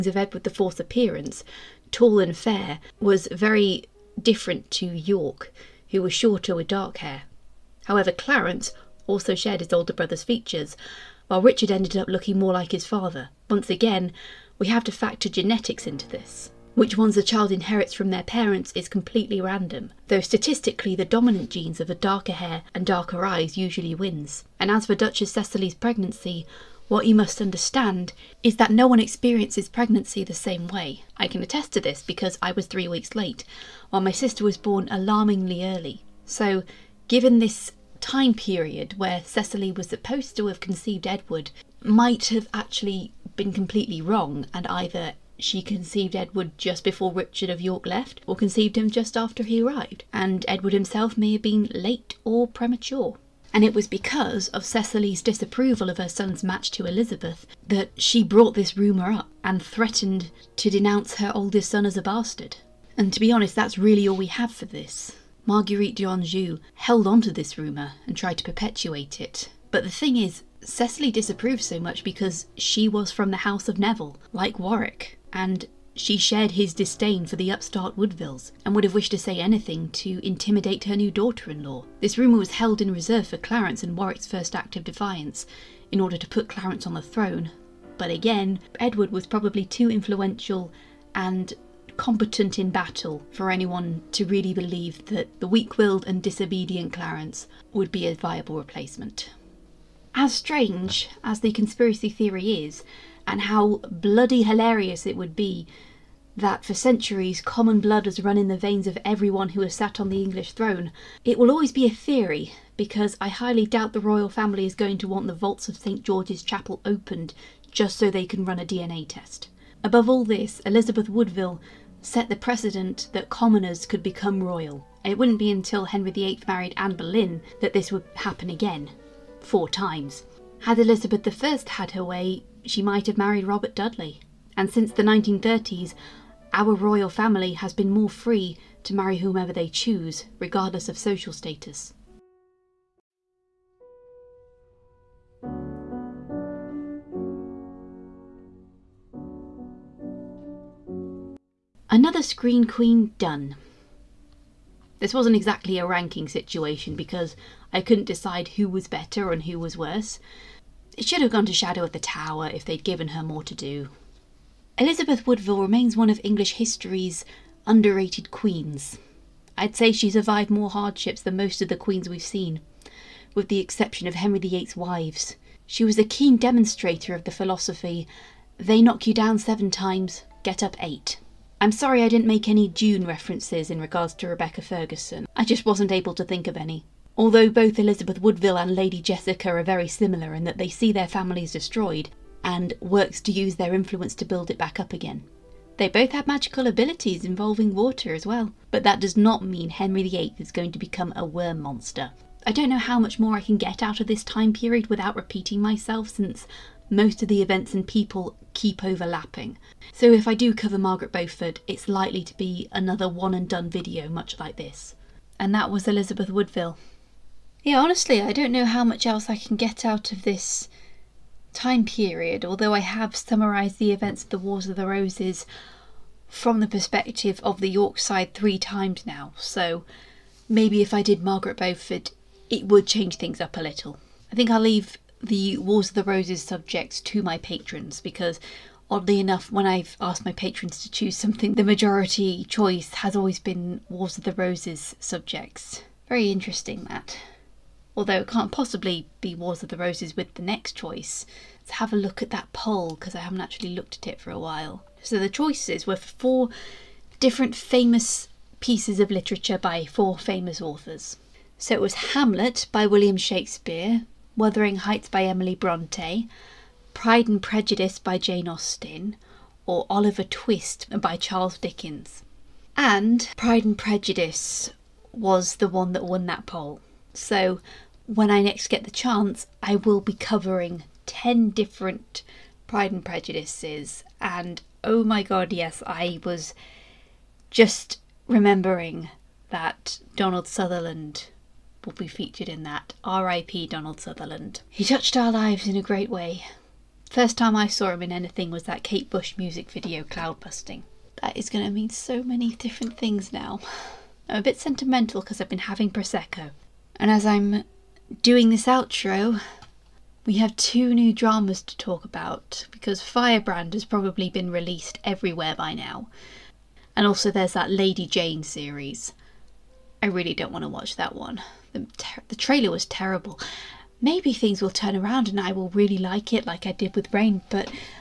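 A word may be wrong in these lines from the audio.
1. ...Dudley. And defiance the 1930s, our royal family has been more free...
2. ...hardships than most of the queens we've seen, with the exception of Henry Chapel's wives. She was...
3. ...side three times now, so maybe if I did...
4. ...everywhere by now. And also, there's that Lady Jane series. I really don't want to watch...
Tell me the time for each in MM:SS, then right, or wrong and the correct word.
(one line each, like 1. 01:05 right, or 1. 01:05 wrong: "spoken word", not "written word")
1. 02:13 wrong: "since", not "defiance"
2. 02:50 wrong: "VIII", not "Chapel"
3. 03:47 right
4. 05:15 right.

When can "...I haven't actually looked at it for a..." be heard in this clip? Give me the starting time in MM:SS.
04:13.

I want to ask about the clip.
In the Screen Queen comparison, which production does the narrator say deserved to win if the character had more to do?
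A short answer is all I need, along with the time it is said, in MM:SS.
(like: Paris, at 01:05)
Shadow at the Tower, at 02:41.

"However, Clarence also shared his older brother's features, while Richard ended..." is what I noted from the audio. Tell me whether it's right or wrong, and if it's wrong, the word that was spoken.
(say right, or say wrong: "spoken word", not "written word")
right.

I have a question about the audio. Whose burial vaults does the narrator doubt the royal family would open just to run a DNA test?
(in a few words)
St George's Chapel.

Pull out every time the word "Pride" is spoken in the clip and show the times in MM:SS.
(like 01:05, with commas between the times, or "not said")
04:26, 04:33, 04:42.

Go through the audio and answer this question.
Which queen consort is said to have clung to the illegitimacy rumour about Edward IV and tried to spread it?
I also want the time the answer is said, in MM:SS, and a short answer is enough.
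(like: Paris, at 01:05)
Marguerite d'Anjou, at 01:05.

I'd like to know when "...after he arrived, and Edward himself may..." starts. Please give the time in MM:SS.
00:49.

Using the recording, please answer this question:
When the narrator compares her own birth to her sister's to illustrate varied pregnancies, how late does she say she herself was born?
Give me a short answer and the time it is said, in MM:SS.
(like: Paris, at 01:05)
3 weeks, at 00:32.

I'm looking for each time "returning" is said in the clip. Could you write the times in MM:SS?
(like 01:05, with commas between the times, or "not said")
not said.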